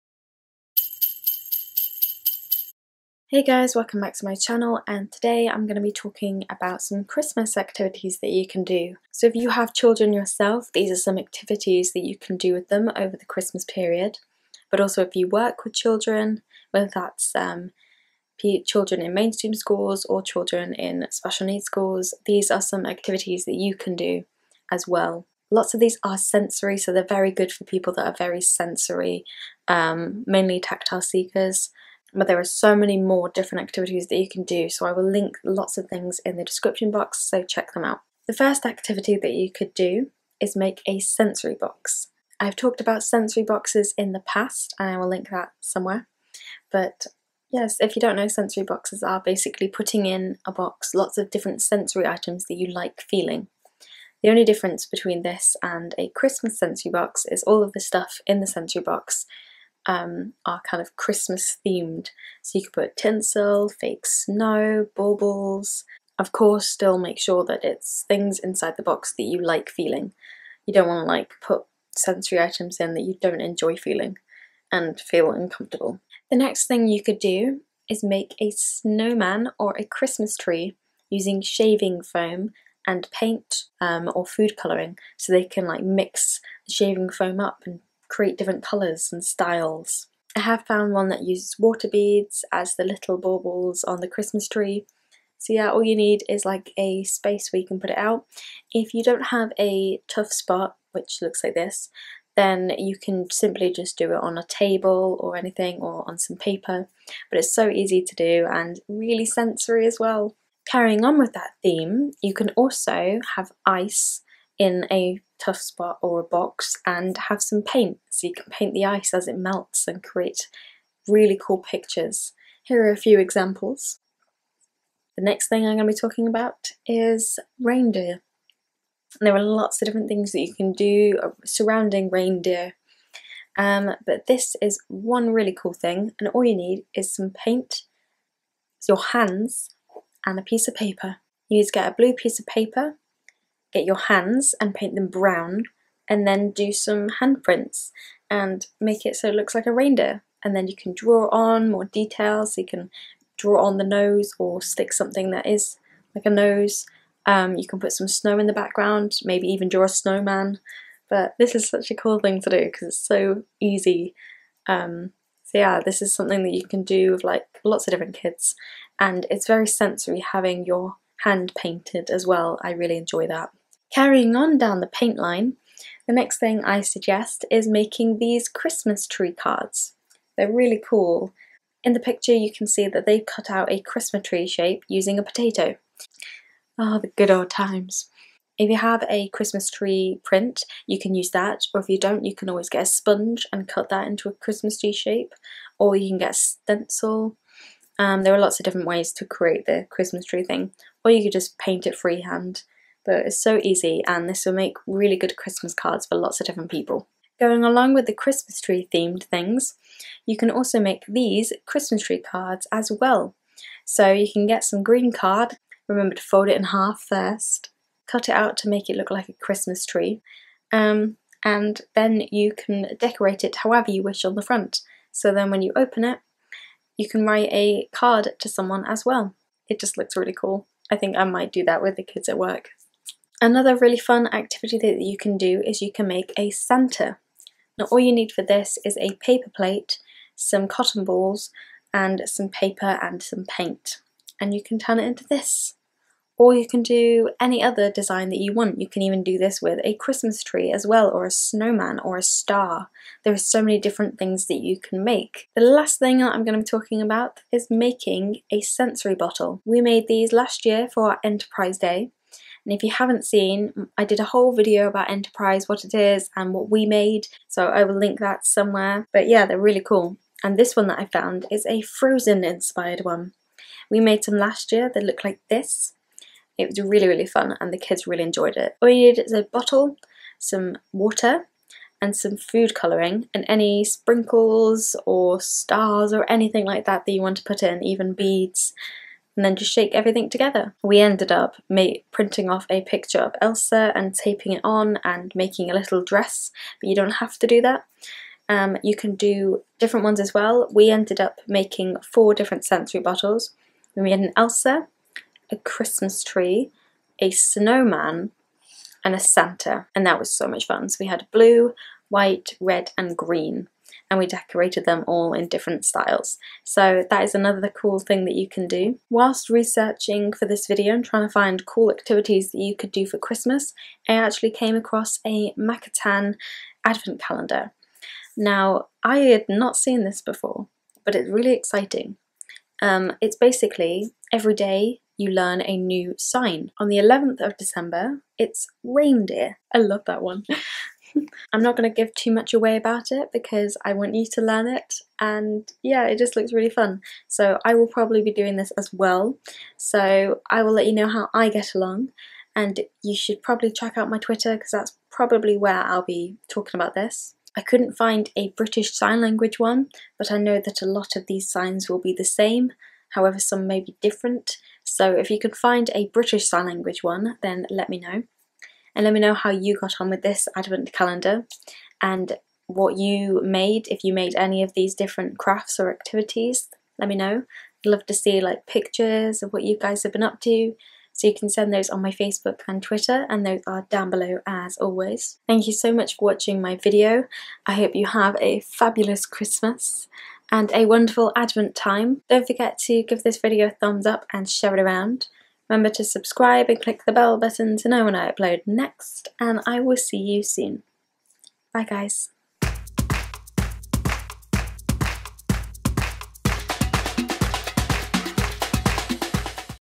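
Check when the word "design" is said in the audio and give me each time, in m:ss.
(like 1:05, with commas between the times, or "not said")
4:07.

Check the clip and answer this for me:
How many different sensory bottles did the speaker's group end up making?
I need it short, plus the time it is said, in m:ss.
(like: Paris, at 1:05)
4, at 5:02.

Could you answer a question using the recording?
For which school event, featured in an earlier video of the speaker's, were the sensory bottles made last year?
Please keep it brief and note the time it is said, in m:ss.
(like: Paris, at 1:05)
Enterprise Day, at 4:21.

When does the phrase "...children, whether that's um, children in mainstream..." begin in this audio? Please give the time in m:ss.
0:15.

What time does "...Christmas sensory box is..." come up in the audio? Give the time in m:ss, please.
0:56.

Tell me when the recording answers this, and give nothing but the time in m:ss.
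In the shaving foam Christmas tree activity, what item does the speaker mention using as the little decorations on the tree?
1:31.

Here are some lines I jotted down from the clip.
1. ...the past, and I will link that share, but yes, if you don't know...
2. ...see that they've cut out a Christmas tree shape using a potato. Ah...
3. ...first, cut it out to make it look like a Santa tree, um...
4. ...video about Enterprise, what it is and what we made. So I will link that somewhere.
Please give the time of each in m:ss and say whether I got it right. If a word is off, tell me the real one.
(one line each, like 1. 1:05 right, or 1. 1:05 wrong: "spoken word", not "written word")
1. 0:44 wrong: "somewhere", not "share"
2. 3:02 right
3. 3:37 wrong: "Christmas", not "Santa"
4. 4:24 right.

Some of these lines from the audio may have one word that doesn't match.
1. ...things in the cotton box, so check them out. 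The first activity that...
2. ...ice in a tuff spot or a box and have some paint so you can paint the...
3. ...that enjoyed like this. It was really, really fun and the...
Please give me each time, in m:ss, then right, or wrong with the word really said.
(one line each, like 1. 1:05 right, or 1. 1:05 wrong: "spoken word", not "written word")
1. 0:35 wrong: "description", not "cotton"
2. 1:53 right
3. 4:34 wrong: "looked", not "enjoyed".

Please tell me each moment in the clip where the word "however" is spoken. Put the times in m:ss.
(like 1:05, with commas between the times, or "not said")
3:43, 6:03.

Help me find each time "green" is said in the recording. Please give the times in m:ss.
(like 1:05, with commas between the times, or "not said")
3:34, 5:13.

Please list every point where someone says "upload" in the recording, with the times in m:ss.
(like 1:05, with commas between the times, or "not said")
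6:38.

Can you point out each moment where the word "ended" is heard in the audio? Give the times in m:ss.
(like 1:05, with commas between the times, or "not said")
4:50, 5:00.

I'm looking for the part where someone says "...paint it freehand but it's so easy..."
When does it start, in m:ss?
3:21.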